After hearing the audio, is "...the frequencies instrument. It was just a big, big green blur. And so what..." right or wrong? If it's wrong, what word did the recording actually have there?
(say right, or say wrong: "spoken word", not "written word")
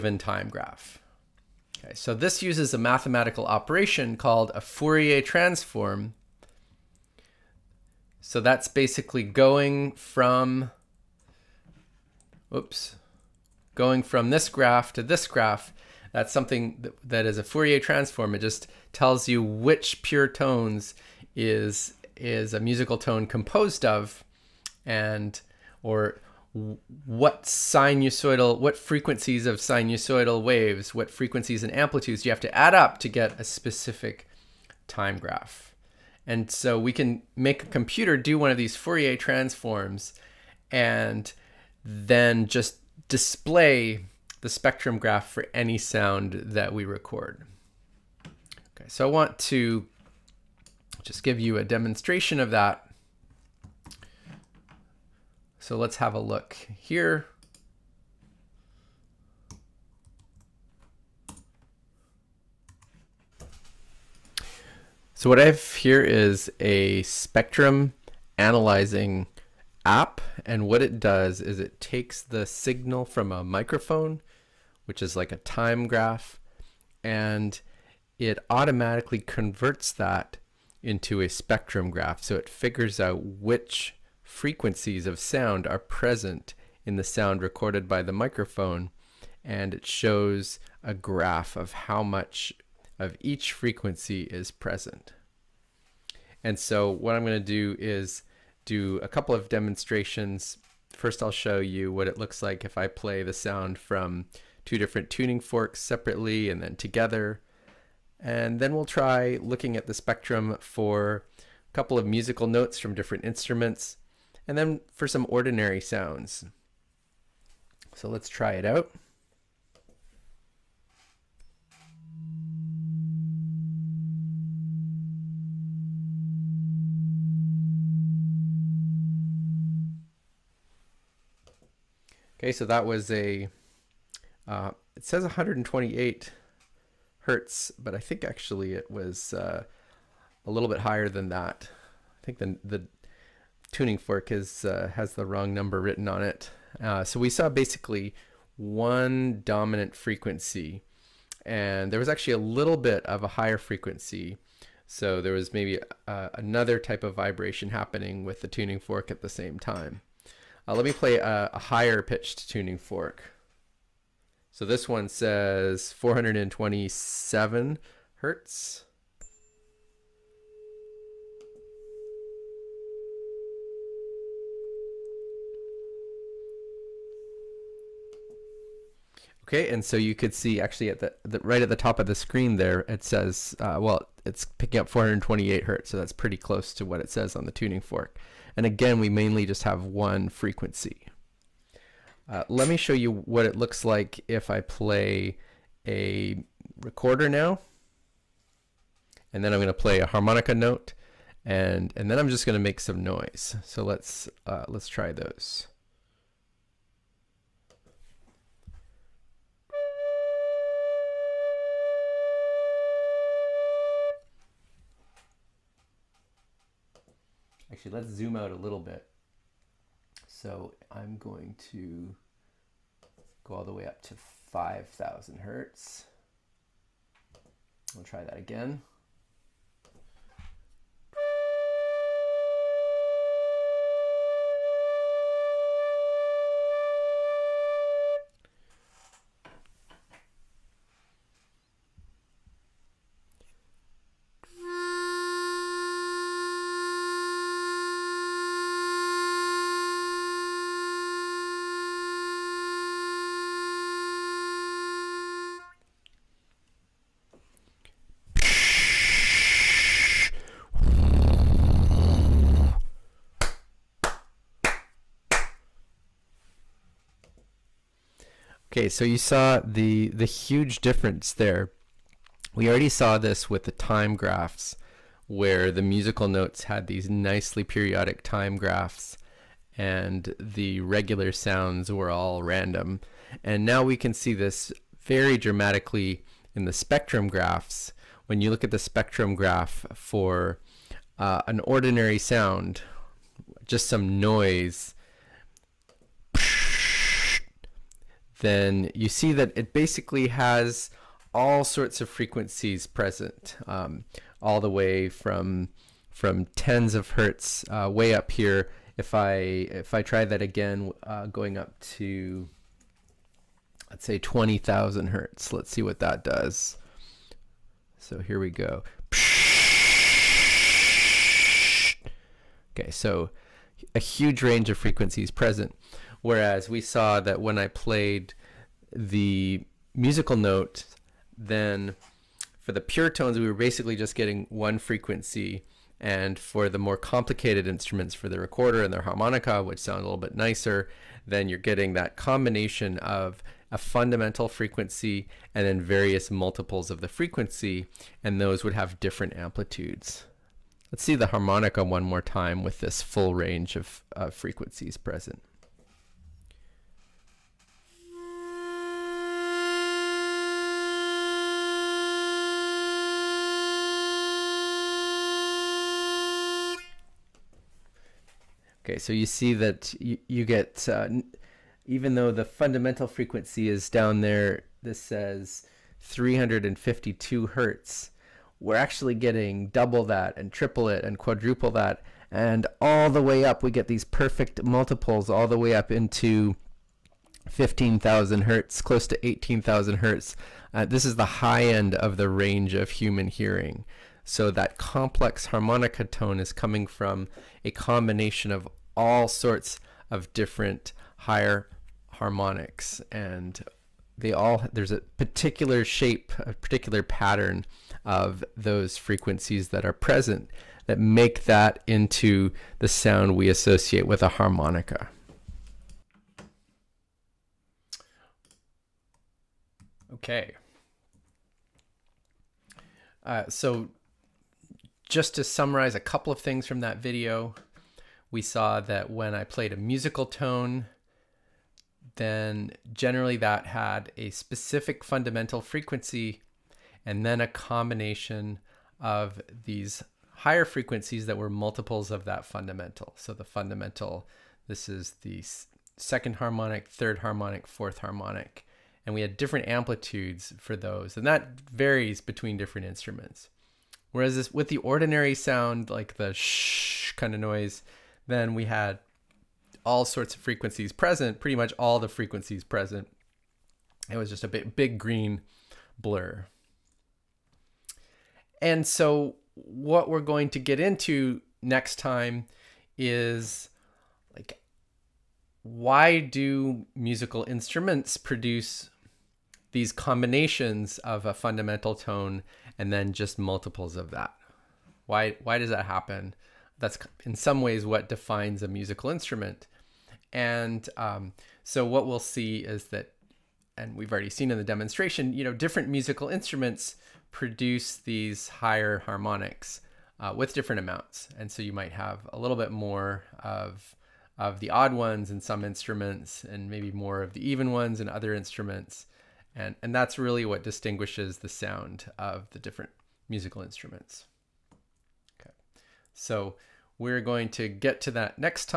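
wrong: "present", not "instrument".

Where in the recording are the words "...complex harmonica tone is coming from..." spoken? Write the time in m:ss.
6:34.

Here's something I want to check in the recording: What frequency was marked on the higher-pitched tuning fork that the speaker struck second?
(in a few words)
427 hertz.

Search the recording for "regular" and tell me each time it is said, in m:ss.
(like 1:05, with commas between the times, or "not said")
4:40.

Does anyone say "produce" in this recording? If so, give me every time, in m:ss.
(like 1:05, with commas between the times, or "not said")
7:58, 8:17.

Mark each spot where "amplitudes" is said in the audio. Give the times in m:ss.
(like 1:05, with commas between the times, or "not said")
0:31, 5:49, 7:29.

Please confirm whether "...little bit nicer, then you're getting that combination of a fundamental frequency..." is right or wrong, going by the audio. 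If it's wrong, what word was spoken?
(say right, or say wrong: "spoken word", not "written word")
right.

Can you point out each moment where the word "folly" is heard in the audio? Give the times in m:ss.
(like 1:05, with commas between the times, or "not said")
not said.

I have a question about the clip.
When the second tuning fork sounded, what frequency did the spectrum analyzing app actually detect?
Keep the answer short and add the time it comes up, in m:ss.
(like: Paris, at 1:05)
428 hertz, at 3:04.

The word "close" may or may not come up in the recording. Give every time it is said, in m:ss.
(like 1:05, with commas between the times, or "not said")
3:06, 6:28.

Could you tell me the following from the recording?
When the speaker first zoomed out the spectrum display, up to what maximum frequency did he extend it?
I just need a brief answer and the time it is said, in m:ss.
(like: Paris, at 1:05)
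5,000 hertz, at 3:44.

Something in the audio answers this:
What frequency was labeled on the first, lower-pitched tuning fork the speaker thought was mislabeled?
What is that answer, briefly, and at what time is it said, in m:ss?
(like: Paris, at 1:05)
128 hertz, at 2:15.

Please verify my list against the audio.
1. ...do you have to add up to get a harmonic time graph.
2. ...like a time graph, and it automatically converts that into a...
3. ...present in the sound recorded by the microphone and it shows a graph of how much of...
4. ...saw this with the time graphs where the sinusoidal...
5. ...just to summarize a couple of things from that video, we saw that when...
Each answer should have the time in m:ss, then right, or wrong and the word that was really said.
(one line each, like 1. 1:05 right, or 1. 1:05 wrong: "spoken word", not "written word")
1. 0:32 wrong: "specific", not "harmonic"
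2. 1:15 right
3. 1:25 right
4. 4:32 wrong: "musical", not "sinusoidal"
5. 7:05 right.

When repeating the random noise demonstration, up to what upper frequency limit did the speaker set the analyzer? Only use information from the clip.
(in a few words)
20,000 hertz.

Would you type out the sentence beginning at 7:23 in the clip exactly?
So the fundamental, this is the second harmonic, third harmonic, fourth harmonic.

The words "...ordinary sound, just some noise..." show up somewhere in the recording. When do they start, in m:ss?
4:51.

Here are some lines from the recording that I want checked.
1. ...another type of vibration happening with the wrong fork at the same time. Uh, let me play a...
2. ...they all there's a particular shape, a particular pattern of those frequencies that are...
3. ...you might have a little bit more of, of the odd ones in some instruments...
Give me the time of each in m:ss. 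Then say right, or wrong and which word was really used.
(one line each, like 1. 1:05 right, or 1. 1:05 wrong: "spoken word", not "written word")
1. 2:36 wrong: "tuning", not "wrong"
2. 6:44 right
3. 8:21 right.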